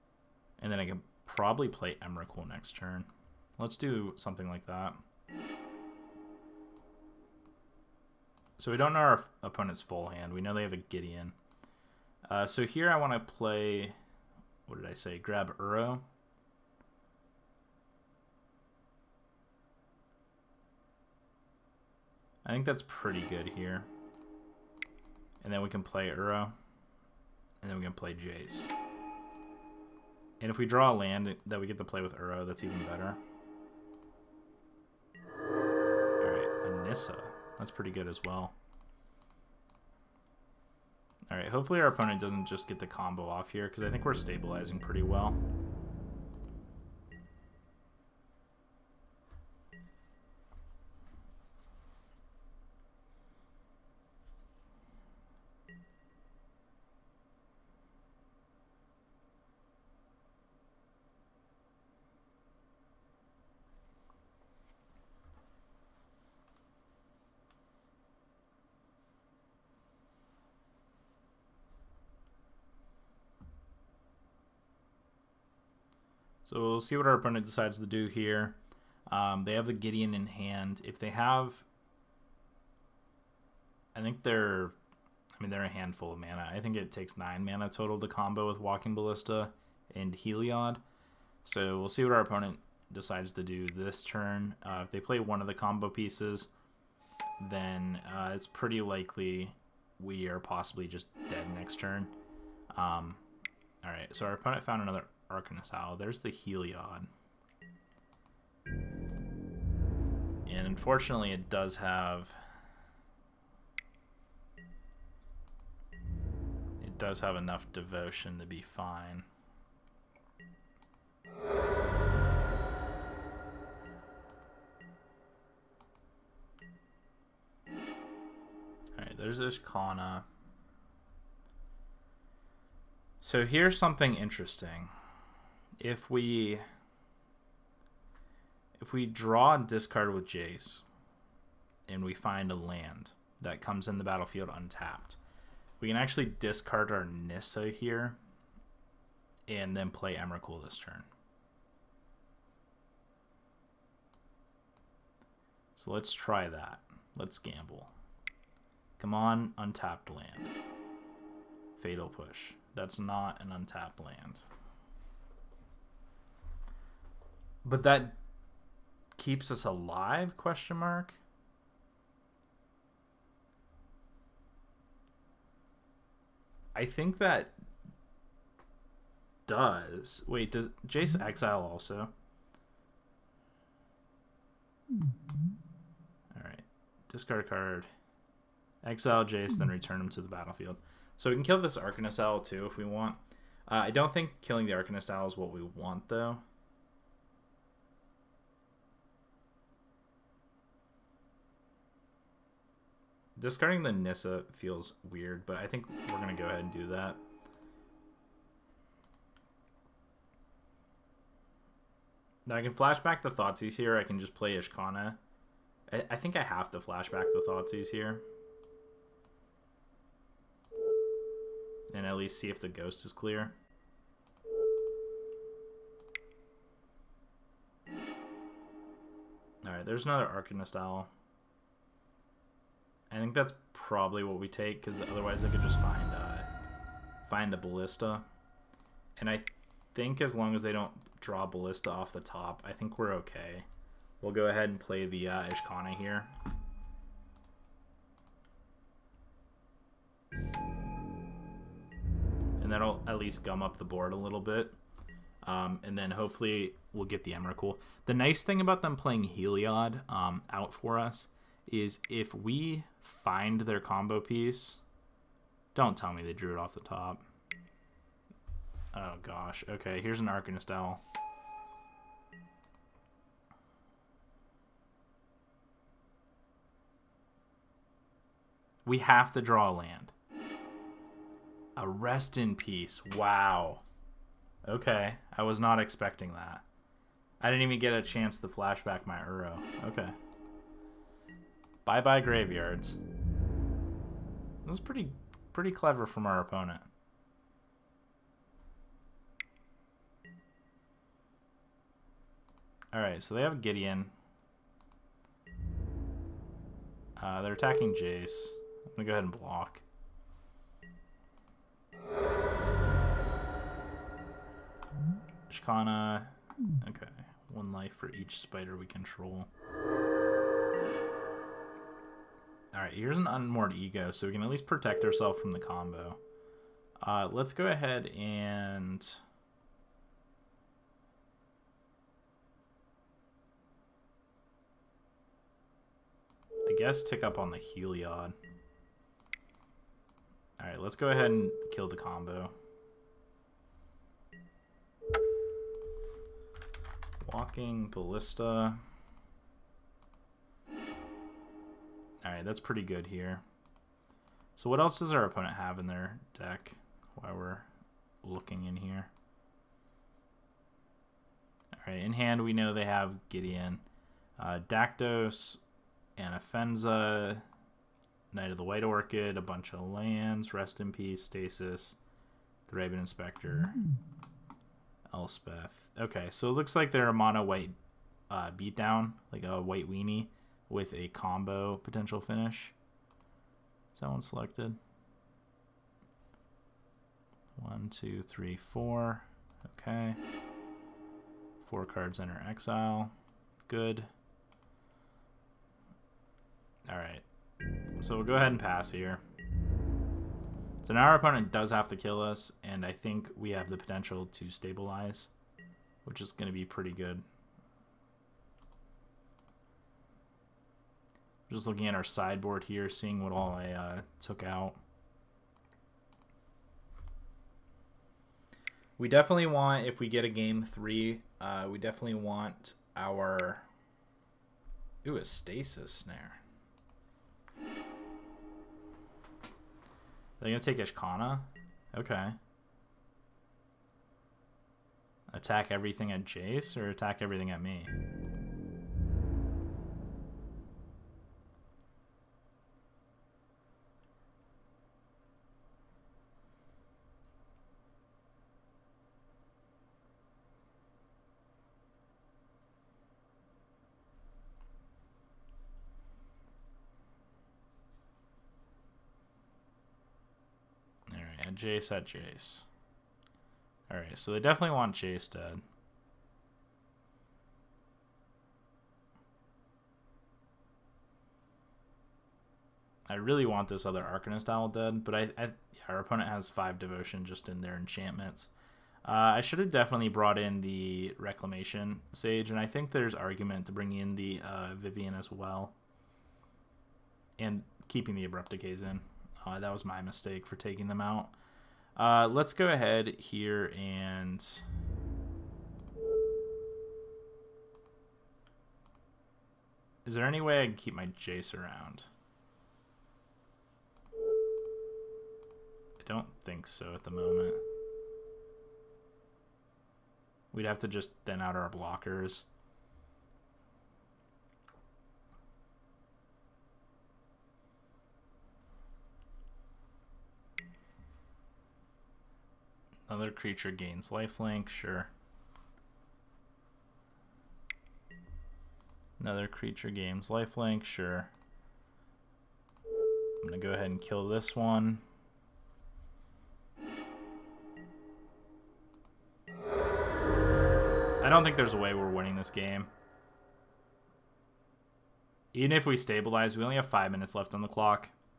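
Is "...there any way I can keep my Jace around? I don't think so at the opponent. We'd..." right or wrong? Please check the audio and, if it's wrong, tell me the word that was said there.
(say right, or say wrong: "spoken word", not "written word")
wrong: "moment", not "opponent".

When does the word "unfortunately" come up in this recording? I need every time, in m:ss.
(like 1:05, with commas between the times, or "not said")
1:50.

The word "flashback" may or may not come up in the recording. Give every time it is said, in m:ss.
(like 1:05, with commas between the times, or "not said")
3:32, 3:36, 4:48.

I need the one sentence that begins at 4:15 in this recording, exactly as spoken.
Um, and then hopefully we'll get the Emrakul.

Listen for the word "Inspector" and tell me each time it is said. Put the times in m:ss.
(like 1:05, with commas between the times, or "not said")
6:13.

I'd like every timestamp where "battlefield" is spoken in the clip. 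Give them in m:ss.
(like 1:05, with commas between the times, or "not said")
2:24, 3:10.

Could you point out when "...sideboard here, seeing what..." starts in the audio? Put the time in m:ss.
6:52.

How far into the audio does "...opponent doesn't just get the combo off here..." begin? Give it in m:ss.
0:41.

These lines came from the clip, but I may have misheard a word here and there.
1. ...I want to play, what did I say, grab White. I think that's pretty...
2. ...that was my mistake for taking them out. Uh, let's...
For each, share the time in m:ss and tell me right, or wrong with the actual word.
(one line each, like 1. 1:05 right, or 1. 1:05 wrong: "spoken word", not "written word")
1. 0:12 wrong: "Uro", not "White"
2. 8:09 right.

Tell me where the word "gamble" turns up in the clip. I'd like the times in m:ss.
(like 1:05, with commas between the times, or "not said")
2:37.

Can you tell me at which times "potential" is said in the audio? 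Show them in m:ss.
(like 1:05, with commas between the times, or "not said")
6:21, 6:43.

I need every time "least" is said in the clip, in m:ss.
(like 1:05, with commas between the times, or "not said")
3:42, 4:13, 5:24.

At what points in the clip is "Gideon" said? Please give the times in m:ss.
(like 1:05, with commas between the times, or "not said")
0:10, 1:19, 5:03, 6:03.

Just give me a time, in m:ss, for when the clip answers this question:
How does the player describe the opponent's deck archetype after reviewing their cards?
6:19.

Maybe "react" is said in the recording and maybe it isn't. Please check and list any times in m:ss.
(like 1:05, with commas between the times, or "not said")
not said.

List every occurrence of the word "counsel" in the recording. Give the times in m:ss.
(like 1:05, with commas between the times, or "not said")
not said.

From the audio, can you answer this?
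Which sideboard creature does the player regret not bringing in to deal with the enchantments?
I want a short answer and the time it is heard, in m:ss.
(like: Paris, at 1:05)
Reclamation Sage, at 8:01.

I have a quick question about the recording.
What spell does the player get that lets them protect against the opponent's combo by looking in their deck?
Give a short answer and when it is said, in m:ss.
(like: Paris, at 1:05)
Unmoored Ego, at 5:23.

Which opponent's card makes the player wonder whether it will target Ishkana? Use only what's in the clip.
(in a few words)
Stasis Snare.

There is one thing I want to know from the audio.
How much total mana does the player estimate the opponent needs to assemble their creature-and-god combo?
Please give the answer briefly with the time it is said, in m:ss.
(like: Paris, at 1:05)
9, at 1:27.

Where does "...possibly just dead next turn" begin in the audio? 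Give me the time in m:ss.
1:40.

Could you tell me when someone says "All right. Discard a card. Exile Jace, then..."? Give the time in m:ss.
3:04.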